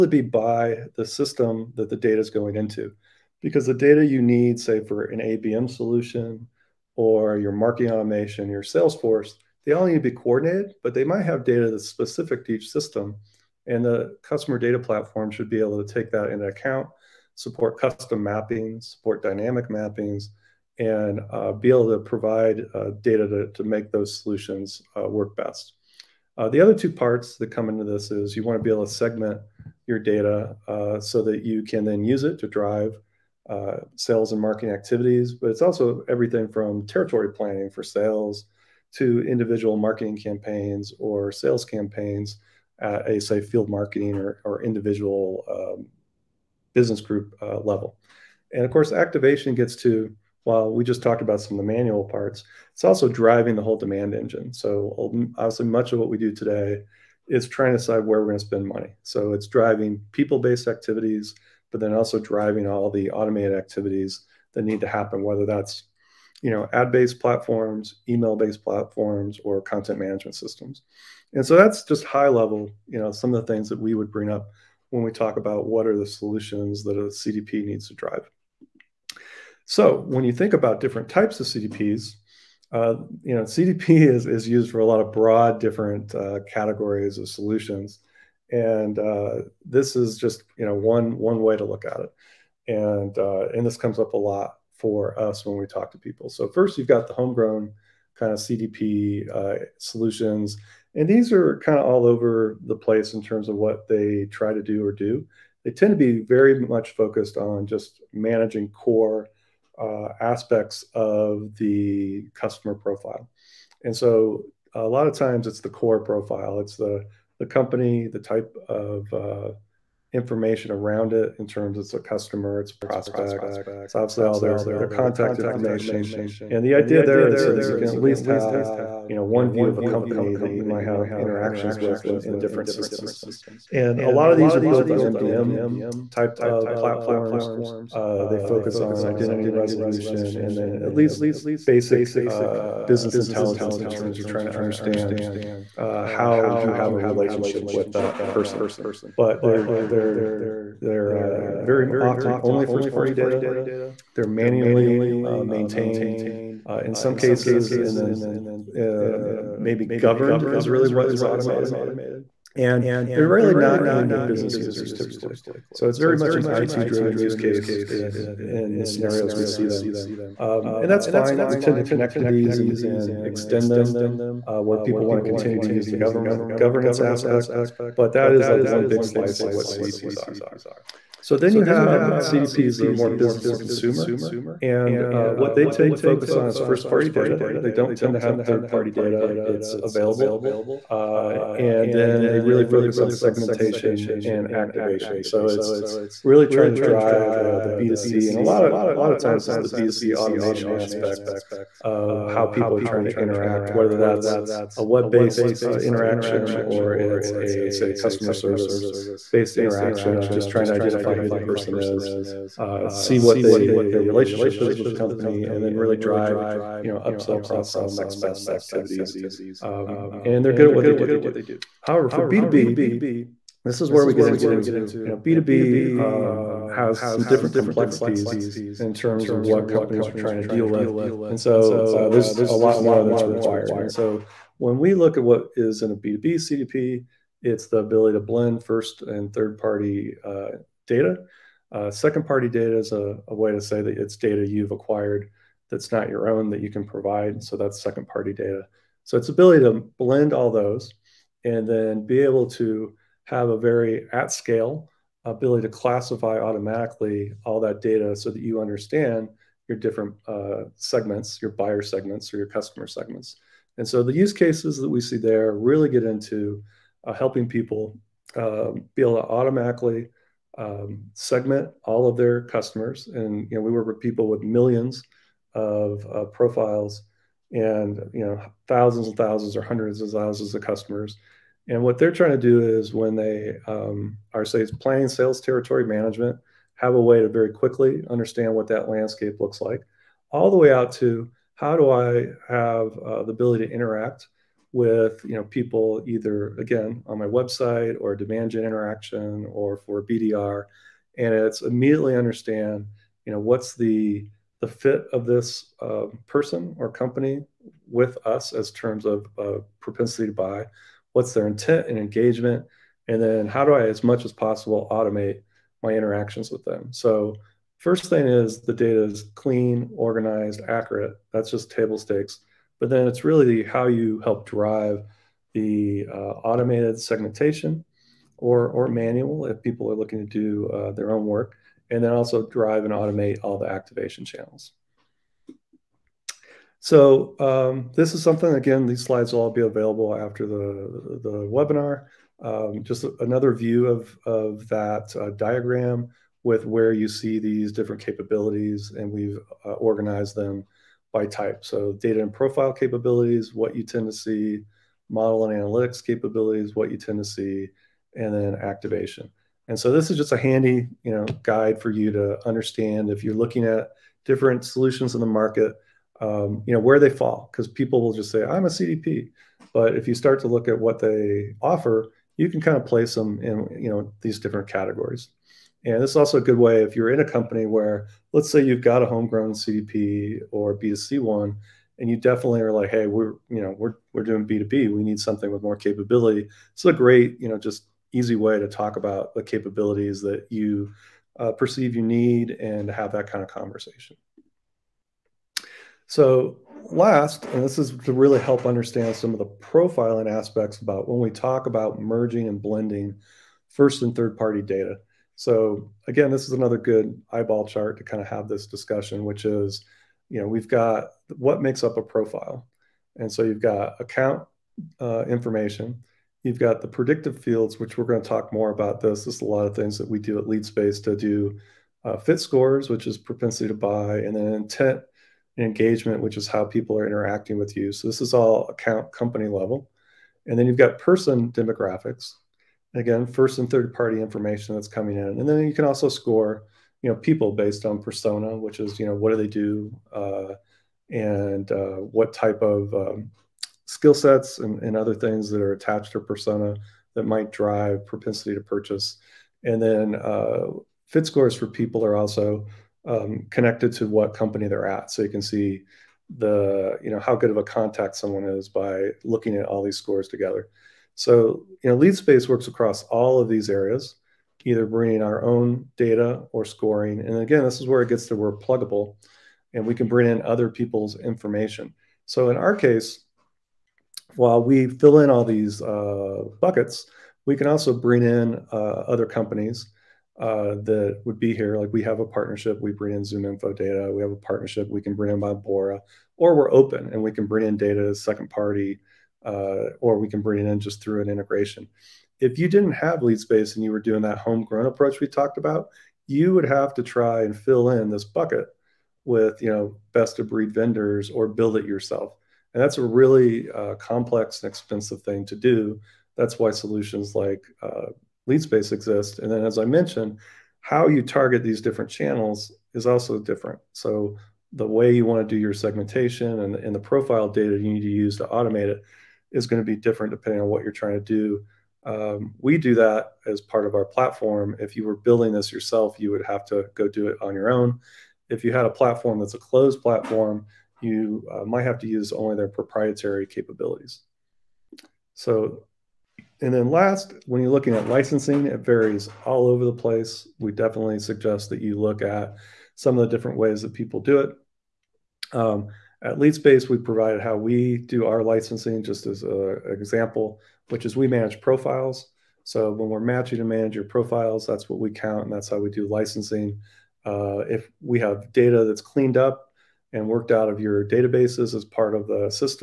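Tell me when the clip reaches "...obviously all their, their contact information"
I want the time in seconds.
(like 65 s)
123 s.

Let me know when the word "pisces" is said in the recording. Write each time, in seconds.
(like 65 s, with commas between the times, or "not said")
not said.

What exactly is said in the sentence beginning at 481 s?
Like we have a partnership, we bring in Zoom Info data.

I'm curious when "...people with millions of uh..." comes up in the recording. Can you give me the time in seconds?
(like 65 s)
274 s.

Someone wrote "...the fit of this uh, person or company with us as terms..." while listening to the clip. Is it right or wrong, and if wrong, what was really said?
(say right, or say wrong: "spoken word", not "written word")
right.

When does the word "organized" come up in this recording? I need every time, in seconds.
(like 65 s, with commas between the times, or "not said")
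319 s, 349 s.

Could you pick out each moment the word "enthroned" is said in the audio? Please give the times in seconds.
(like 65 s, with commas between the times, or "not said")
not said.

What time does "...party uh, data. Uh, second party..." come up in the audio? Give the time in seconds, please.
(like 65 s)
239 s.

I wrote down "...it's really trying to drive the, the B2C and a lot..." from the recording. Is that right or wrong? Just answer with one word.
right.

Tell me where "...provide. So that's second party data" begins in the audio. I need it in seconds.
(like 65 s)
246 s.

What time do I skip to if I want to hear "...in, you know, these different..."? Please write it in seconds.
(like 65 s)
373 s.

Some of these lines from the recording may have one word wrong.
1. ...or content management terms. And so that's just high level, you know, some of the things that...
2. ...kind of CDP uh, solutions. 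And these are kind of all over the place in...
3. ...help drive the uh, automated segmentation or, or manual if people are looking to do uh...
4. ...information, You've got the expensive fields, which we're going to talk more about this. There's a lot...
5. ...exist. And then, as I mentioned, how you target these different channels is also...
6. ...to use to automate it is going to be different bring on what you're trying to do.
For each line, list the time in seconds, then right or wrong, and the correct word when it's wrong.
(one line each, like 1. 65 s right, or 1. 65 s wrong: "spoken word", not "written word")
1. 69 s wrong: "systems", not "terms"
2. 98 s right
3. 324 s right
4. 415 s wrong: "predictive", not "expensive"
5. 508 s right
6. 518 s wrong: "depending", not "bring".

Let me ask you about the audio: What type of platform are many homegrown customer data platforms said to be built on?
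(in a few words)
MDM.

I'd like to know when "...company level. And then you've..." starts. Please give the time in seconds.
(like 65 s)
429 s.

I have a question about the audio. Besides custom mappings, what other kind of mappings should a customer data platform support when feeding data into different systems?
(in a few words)
Dynamic mappings.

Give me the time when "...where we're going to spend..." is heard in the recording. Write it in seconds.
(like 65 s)
58 s.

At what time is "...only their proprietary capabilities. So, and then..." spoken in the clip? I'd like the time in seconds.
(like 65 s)
532 s.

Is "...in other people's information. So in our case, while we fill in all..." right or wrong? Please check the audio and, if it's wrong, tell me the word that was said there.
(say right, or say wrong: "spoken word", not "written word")
right.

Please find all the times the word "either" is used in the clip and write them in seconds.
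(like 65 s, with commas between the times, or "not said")
296 s, 464 s.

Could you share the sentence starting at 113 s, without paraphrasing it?
And so a lot of times it's the core profile.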